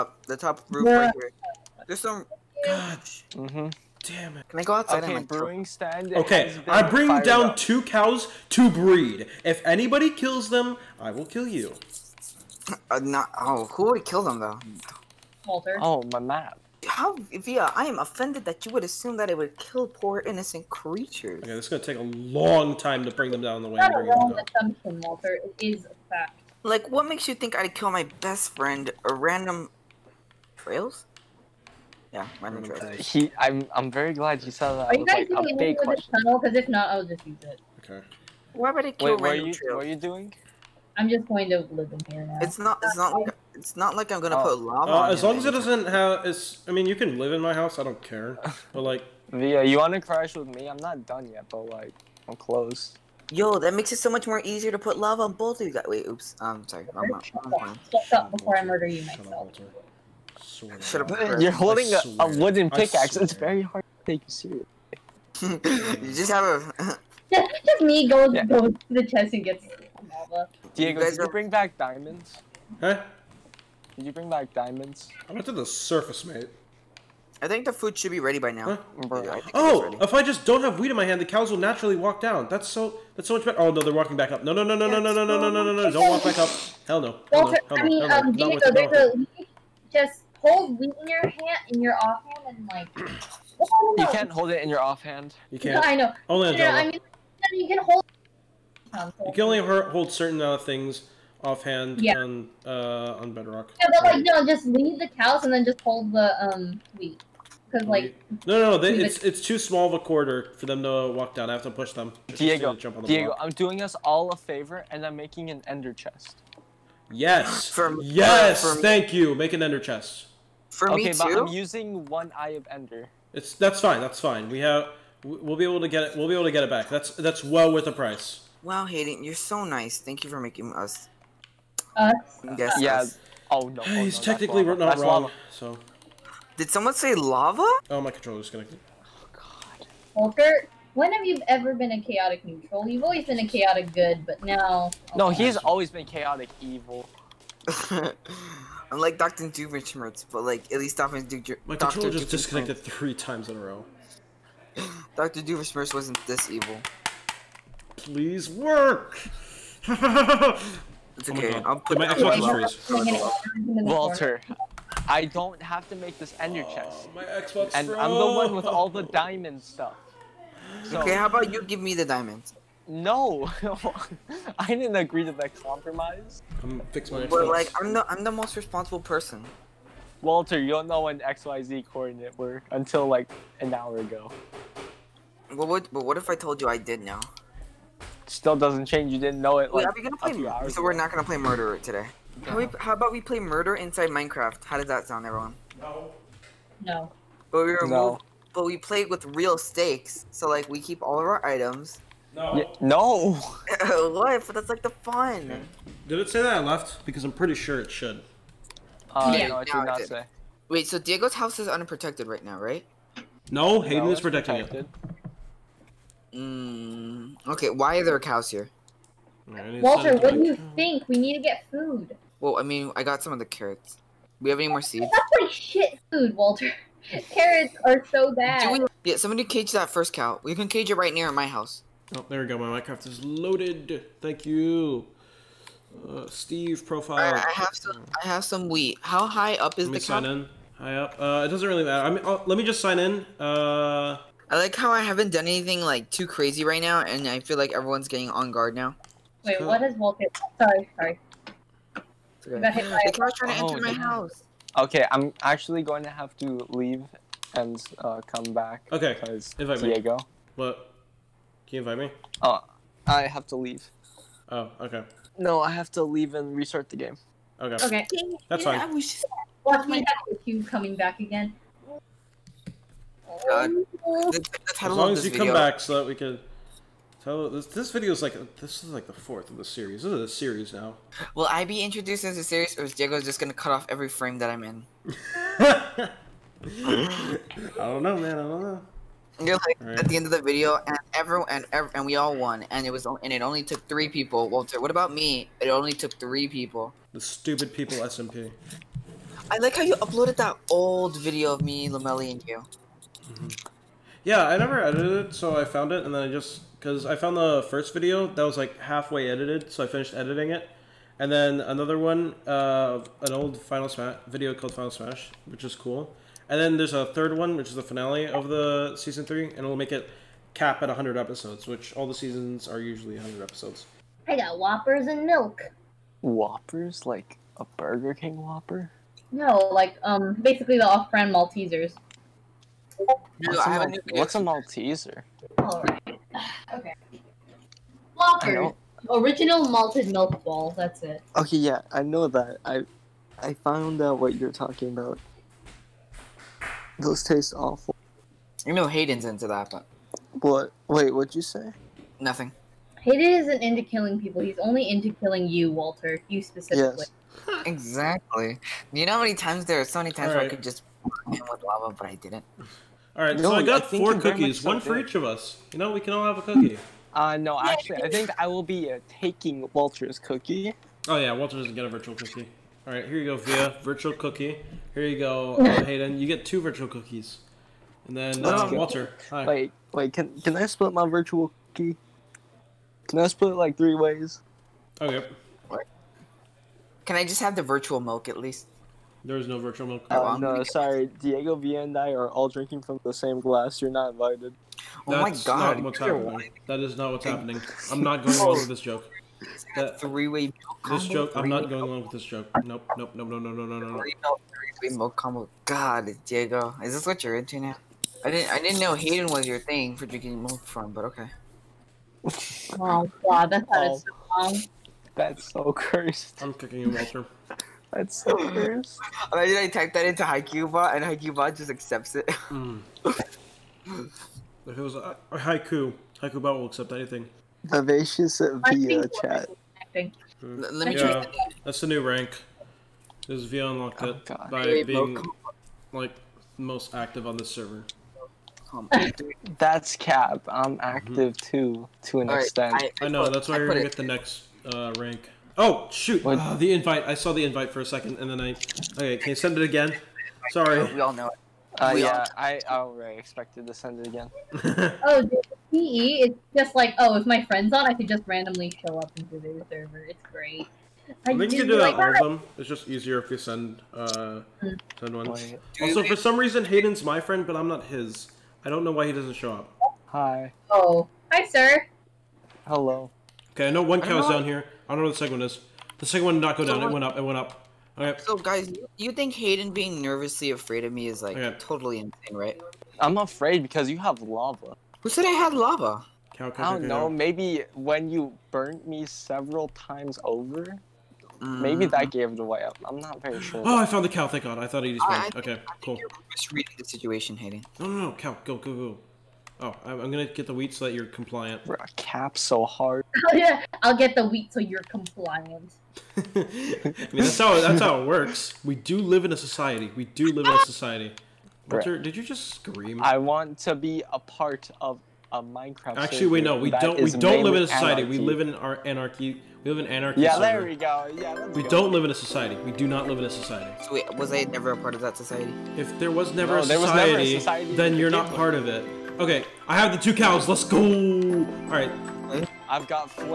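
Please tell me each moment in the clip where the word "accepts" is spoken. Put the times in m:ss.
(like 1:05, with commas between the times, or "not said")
7:01, 7:06.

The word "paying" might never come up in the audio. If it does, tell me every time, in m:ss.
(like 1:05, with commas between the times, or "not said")
not said.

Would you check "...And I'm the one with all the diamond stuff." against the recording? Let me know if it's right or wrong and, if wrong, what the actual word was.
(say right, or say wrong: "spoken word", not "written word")
right.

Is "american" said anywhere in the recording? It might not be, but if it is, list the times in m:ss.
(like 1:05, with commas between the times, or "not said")
not said.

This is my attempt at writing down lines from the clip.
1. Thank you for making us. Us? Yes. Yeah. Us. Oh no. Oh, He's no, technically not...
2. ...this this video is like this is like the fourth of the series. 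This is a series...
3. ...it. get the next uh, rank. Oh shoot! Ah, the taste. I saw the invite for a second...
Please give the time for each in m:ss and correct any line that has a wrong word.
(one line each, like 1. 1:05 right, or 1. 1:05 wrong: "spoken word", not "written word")
1. 2:09 right
2. 4:37 right
3. 7:23 wrong: "invite", not "taste".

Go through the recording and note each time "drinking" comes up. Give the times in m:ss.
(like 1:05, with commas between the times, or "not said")
6:32, 6:50.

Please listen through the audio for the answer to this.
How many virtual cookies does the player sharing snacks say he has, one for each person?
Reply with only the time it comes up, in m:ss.
6:03.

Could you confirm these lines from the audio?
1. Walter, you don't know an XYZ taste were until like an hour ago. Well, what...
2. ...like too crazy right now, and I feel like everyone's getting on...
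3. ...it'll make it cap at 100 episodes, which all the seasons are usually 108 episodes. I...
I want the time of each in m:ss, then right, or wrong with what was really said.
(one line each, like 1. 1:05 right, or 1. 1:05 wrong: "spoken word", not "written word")
1. 3:00 wrong: "coordinate", not "taste"
2. 4:05 right
3. 5:19 wrong: "100", not "108".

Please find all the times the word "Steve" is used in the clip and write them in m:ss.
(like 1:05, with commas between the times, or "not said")
3:56.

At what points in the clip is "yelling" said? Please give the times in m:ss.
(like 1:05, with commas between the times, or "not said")
not said.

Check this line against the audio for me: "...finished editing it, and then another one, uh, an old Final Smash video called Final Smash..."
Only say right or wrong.
right.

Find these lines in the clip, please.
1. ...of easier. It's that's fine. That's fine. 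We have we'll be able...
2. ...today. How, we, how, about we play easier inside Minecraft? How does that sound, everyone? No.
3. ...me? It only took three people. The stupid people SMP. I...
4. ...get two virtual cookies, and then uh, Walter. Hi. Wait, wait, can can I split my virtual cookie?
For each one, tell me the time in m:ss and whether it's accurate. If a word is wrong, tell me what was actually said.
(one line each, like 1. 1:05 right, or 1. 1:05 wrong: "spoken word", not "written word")
1. 2:02 wrong: "ender", not "easier"
2. 3:11 wrong: "murder", not "easier"
3. 4:55 right
4. 6:16 right.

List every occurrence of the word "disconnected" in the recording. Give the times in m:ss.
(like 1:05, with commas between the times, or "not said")
2:18, 2:32.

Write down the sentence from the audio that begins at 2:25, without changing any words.
Oh, no, he's always been chaotic evil.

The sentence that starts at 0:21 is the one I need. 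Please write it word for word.
Okay, this is gonna take a long time to bring them down the way.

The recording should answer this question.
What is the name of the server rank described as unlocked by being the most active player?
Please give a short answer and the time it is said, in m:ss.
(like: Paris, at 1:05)
Vivacious via, at 7:07.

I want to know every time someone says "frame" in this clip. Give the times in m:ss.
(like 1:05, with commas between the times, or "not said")
4:44.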